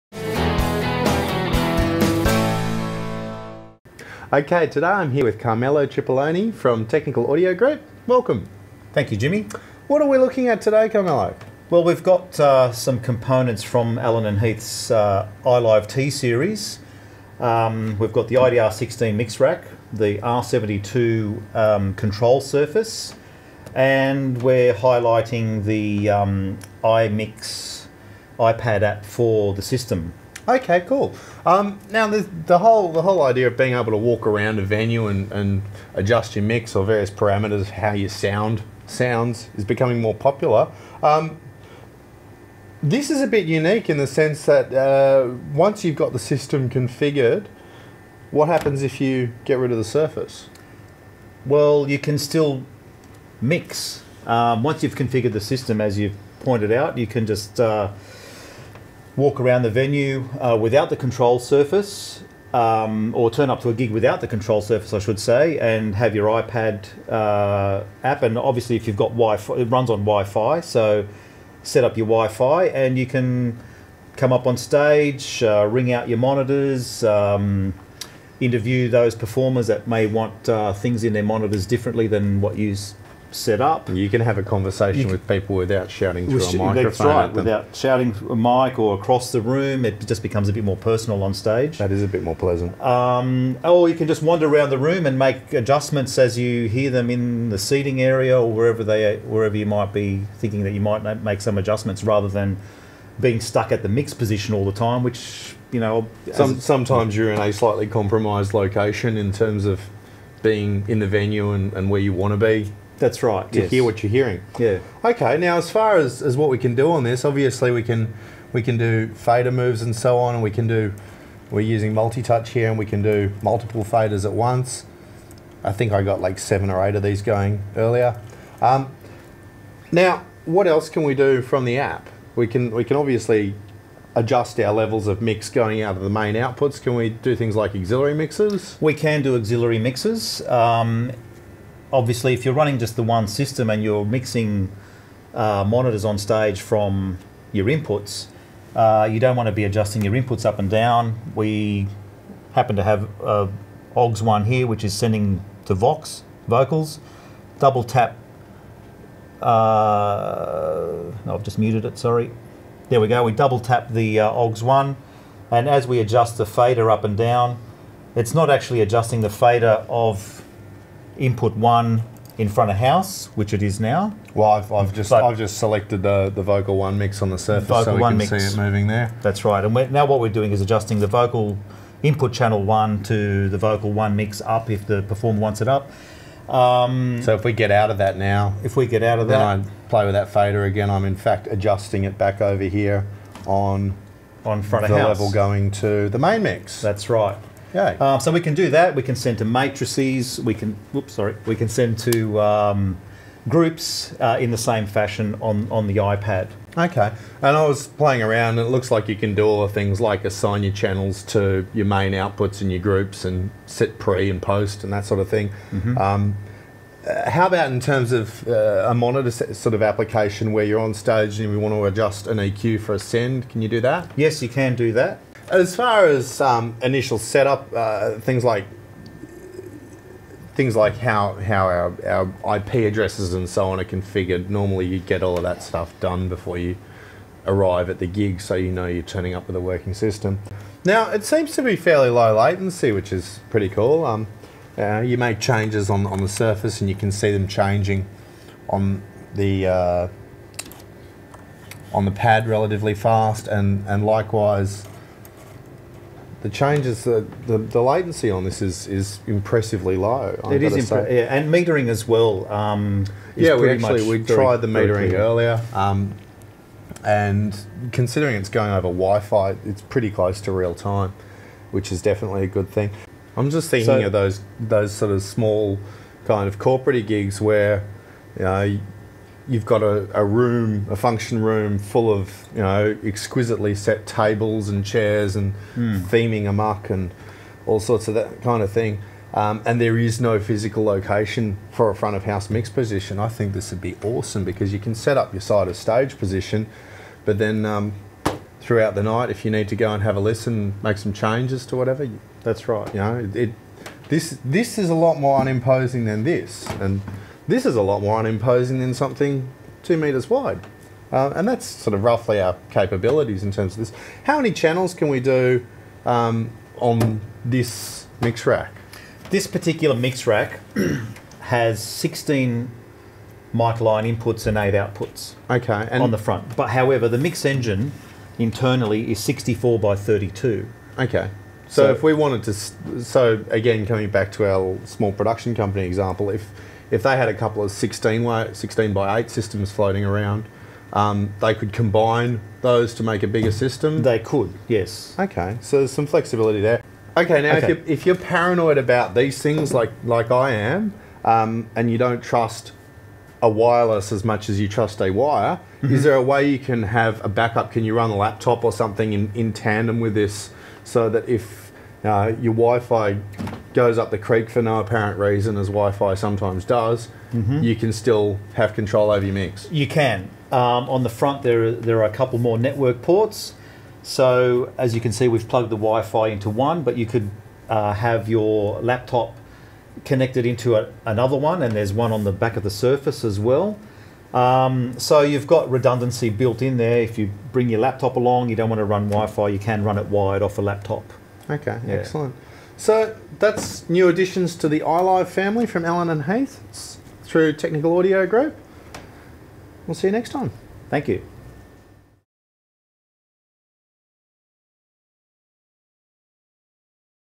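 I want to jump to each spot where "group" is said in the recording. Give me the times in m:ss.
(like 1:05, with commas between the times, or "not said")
0:07, 3:23, 3:32, 6:38.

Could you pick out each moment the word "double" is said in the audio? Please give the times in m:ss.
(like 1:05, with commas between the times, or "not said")
2:37, 2:43.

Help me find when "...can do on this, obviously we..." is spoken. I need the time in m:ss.
1:56.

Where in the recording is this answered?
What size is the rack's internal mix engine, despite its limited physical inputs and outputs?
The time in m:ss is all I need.
5:29.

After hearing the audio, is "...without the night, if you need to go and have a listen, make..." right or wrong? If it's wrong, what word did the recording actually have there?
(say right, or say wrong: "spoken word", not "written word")
wrong: "throughout", not "without".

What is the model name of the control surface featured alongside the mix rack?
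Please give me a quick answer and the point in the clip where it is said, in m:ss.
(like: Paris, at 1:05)
R72, at 0:20.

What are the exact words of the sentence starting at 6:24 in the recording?
Um, so you've got redundancy built in there.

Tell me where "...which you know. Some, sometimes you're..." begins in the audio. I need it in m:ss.
1:45.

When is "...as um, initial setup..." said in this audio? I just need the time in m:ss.
3:46.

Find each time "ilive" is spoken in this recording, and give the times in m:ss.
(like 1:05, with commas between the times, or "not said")
0:15, 6:34.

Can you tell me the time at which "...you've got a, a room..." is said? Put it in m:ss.
4:39.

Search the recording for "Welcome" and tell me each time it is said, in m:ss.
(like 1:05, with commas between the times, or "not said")
0:08.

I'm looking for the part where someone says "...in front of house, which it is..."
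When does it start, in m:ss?
2:52.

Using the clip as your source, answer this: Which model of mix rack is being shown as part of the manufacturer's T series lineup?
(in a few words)
IDR16.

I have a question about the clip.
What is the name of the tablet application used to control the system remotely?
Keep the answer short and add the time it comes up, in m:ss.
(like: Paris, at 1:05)
iMix, at 0:26.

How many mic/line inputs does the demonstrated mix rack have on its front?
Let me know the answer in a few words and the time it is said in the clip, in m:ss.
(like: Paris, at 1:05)
16, at 5:21.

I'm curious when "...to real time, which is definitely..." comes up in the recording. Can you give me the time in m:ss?
4:30.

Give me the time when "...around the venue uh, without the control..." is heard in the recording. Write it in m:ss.
0:59.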